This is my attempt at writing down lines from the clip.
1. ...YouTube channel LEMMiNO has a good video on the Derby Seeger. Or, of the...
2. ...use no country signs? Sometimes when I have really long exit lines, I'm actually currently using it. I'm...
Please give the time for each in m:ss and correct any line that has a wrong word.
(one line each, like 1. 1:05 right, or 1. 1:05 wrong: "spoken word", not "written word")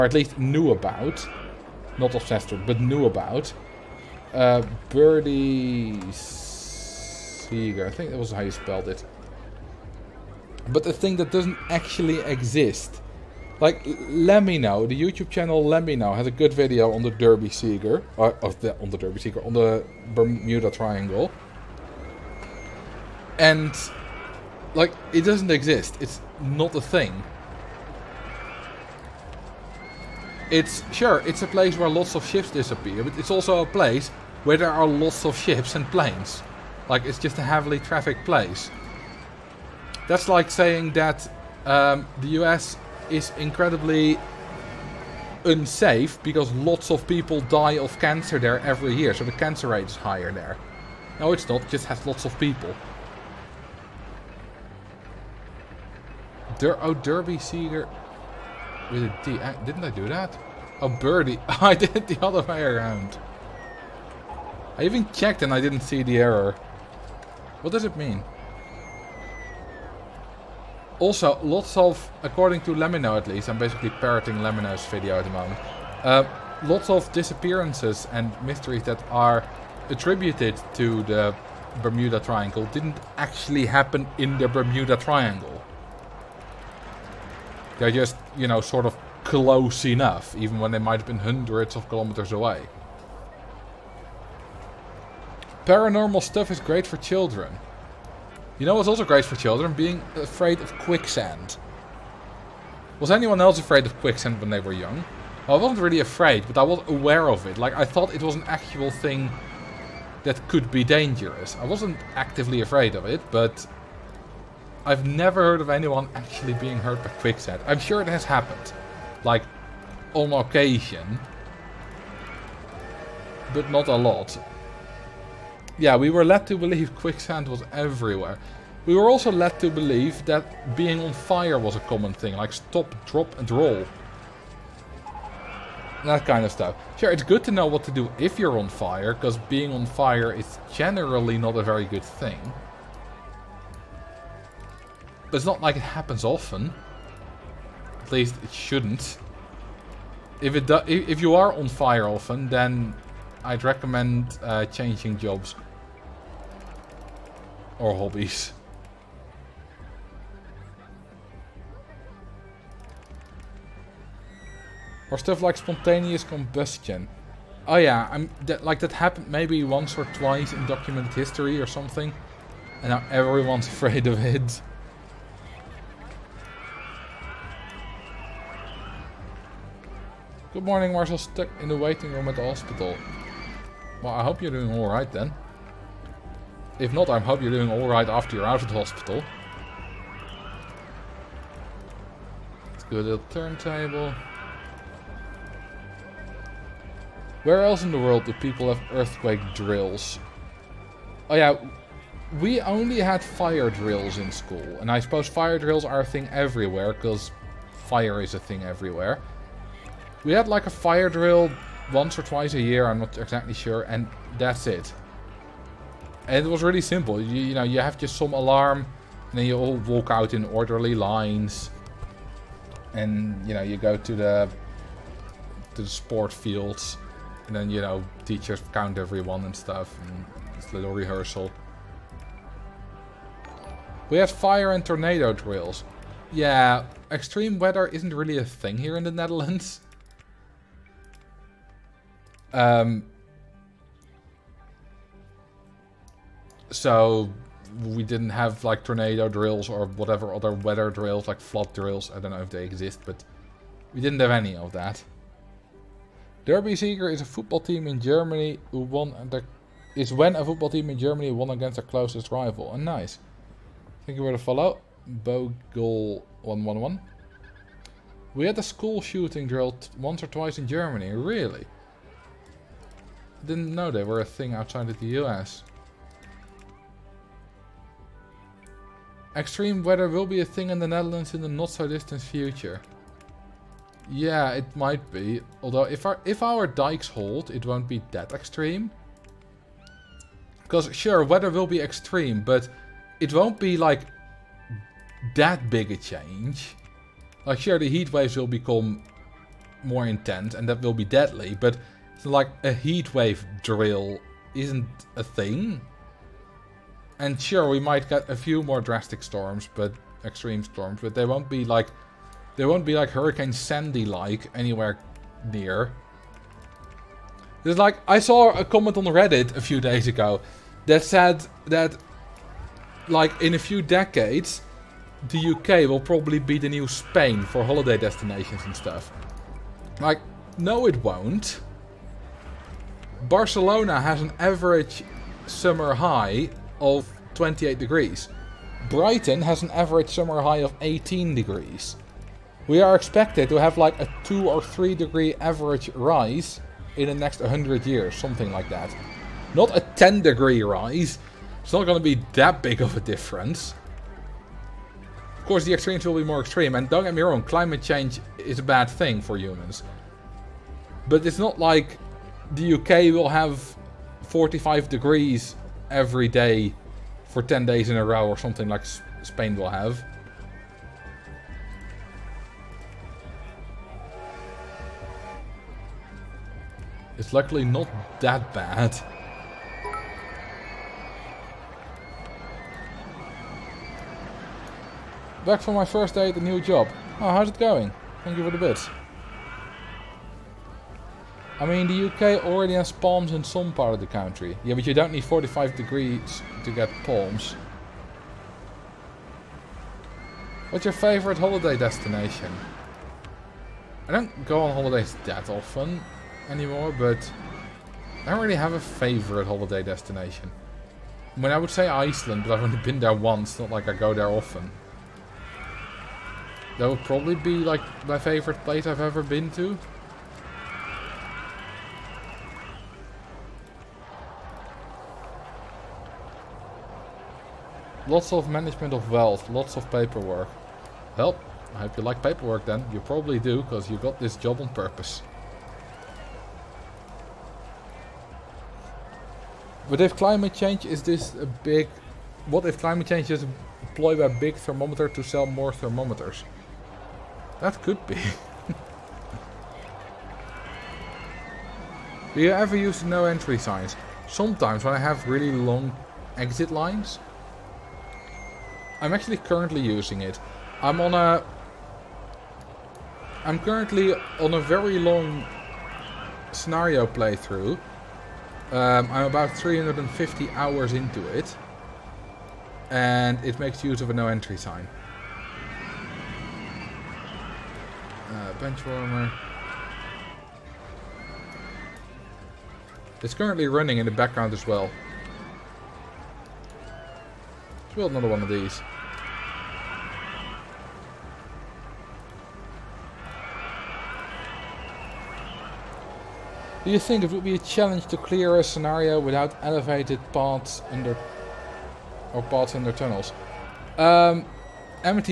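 1. 0:15 right
2. 7:32 wrong: "entry", not "country".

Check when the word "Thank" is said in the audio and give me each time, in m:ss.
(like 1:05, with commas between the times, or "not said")
4:24, 6:28.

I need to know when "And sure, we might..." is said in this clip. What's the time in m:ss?
5:07.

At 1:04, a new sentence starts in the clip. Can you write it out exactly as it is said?
I even checked and I didn't see the error.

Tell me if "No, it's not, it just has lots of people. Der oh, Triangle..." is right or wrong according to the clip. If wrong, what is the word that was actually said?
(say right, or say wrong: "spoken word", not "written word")
wrong: "Derby", not "Triangle".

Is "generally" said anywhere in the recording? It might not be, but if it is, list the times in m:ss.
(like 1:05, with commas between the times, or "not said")
2:20.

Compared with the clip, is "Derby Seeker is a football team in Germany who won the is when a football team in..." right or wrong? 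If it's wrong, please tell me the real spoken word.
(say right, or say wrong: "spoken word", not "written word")
right.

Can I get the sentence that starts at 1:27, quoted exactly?
They're just, you know, sort of close enough, even when they might have been hundreds of kilometers away.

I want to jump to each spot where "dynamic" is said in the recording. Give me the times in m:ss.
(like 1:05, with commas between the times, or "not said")
not said.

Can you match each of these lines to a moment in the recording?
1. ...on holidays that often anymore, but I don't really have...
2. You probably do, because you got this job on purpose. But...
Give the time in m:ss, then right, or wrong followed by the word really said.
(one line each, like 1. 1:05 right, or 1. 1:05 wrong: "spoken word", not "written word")
1. 6:44 right
2. 7:12 right.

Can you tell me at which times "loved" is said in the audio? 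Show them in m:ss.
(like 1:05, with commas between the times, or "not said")
not said.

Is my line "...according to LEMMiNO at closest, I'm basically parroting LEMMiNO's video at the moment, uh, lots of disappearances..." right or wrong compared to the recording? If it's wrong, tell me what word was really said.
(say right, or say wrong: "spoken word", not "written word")
wrong: "least", not "closest".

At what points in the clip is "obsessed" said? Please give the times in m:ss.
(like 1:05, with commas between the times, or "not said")
0:02.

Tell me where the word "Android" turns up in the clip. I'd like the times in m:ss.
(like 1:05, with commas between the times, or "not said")
not said.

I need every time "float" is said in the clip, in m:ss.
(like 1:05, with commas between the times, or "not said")
not said.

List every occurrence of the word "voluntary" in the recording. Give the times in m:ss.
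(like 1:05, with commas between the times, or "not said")
not said.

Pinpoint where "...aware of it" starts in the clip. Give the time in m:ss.
1:46.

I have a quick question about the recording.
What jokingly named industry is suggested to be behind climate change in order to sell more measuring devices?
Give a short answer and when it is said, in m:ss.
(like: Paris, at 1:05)
Big thermometer, at 7:24.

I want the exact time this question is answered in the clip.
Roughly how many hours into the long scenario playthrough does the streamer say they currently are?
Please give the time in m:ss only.
7:49.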